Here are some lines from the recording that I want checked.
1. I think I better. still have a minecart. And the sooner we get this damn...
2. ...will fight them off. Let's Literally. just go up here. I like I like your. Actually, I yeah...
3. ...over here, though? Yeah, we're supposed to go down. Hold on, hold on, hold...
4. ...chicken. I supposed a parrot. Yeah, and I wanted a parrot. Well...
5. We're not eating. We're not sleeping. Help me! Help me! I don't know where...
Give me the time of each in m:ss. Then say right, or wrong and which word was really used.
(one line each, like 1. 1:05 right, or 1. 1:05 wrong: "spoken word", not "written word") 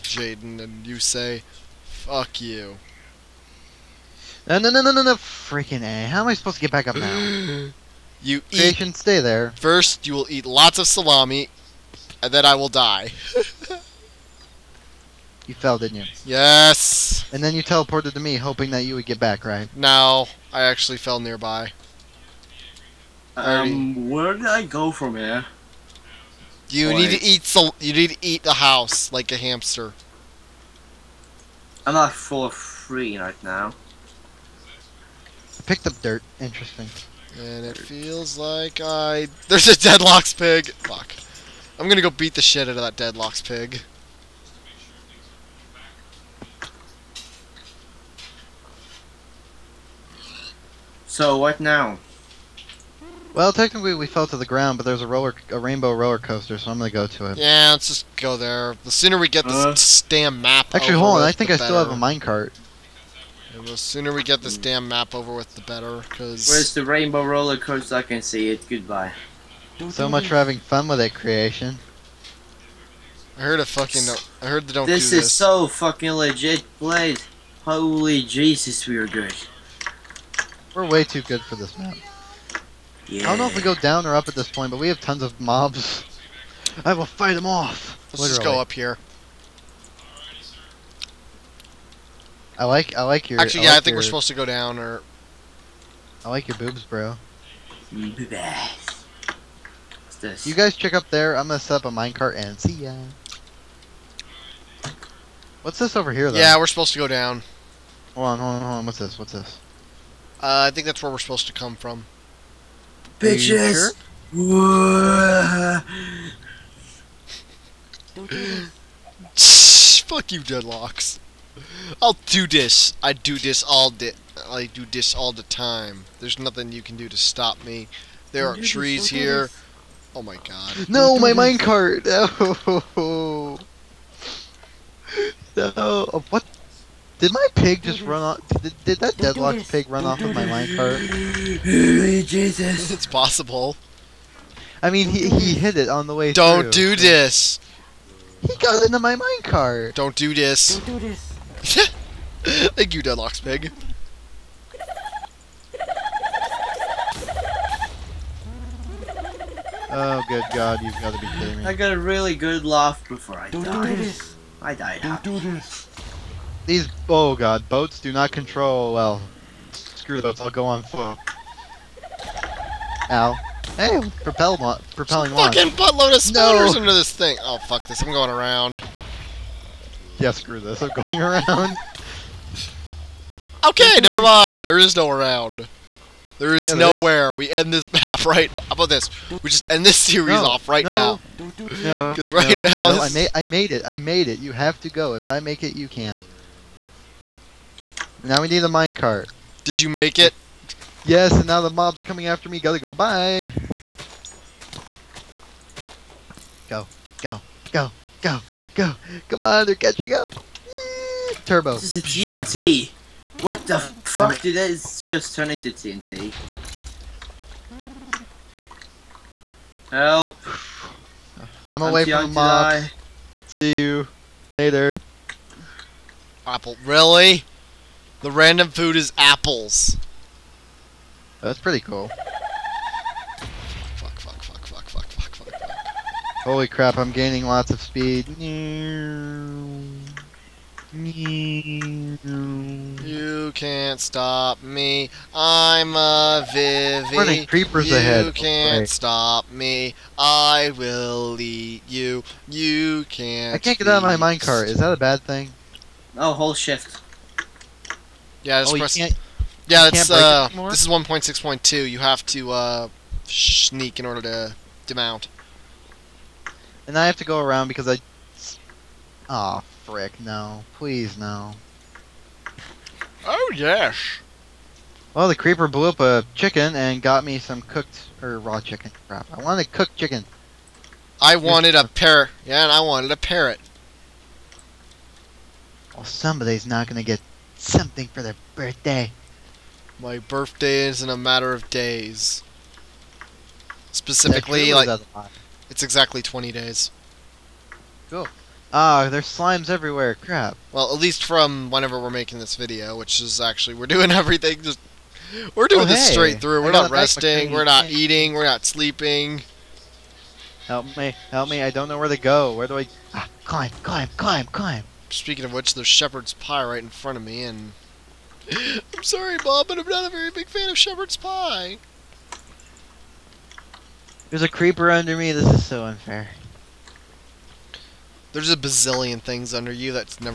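1. 1:01 right
2. 1:26 right
3. 1:45 right
4. 4:39 wrong: "wanted", not "supposed"
5. 5:07 right.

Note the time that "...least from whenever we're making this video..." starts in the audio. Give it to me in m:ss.
5:00.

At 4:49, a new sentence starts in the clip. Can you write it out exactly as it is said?
My birthday is in a matter of days.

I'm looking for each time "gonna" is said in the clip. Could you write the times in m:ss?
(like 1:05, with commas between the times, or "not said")
0:41, 0:56, 1:41.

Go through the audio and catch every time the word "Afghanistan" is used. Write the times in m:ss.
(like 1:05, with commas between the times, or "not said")
not said.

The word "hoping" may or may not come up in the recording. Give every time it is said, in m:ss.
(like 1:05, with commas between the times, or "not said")
0:18.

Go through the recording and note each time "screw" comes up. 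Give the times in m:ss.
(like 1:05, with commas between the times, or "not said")
2:49, 3:00.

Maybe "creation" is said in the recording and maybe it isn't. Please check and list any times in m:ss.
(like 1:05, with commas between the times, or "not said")
0:08, 1:11.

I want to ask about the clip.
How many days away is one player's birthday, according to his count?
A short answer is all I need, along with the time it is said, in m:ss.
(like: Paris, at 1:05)
20, at 4:56.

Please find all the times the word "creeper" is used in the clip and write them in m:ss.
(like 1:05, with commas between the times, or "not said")
4:07, 4:35, 5:24.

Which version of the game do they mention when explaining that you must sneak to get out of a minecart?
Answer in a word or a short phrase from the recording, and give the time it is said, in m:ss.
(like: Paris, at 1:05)
1.6.2, at 4:20.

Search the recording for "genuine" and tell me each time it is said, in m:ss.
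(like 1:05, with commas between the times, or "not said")
not said.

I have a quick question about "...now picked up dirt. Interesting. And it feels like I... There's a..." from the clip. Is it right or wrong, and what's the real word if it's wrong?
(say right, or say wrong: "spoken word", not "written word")
right.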